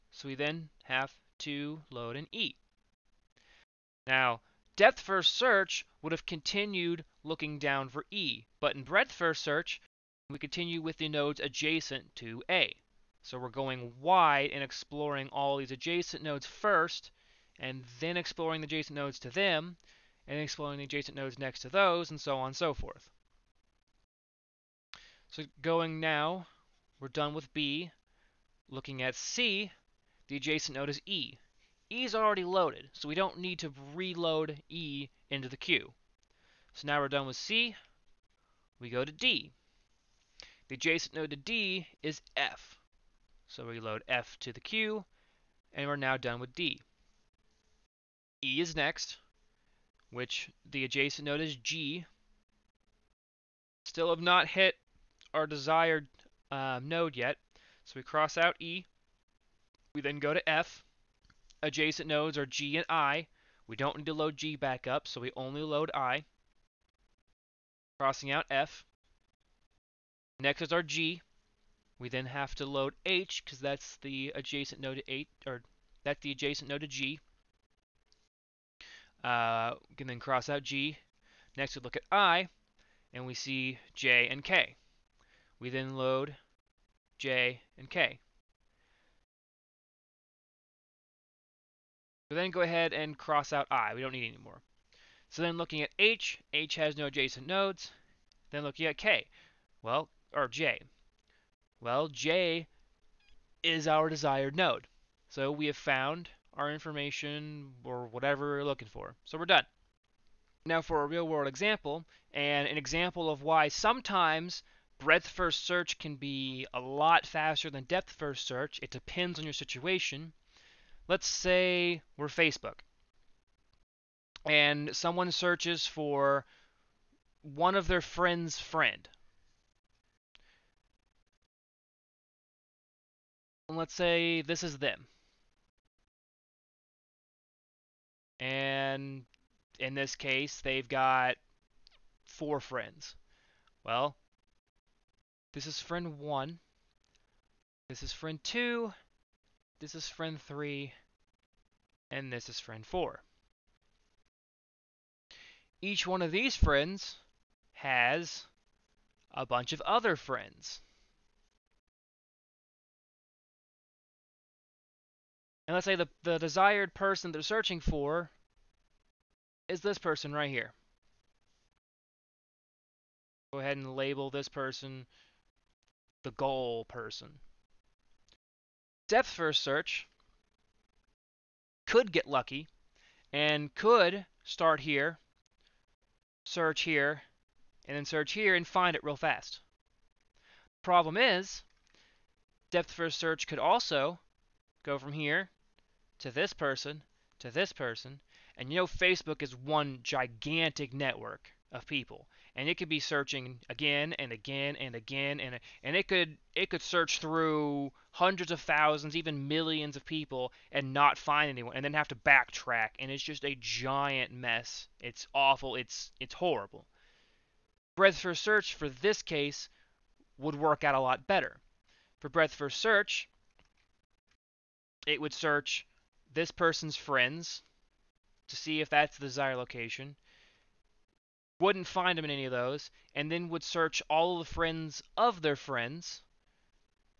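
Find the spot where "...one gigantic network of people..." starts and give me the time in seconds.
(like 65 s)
199 s.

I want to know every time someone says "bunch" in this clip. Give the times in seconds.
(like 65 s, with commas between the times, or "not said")
159 s.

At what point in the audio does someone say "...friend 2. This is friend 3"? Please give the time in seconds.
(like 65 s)
148 s.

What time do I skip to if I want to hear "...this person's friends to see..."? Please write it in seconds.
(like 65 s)
226 s.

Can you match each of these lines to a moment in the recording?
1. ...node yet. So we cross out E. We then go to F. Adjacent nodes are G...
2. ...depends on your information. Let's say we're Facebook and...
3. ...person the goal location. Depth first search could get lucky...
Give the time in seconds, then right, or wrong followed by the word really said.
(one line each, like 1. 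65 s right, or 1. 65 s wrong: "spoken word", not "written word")
1. 56 s right
2. 118 s wrong: "situation", not "information"
3. 174 s wrong: "person", not "location".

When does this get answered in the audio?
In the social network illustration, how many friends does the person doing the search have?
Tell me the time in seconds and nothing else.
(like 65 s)
142 s.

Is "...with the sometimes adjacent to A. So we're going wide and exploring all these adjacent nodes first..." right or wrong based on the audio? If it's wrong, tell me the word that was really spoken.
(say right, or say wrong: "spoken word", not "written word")
wrong: "nodes", not "sometimes".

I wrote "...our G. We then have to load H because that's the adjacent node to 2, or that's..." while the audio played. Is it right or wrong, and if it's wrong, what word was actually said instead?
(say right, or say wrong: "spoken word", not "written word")
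wrong: "8", not "2".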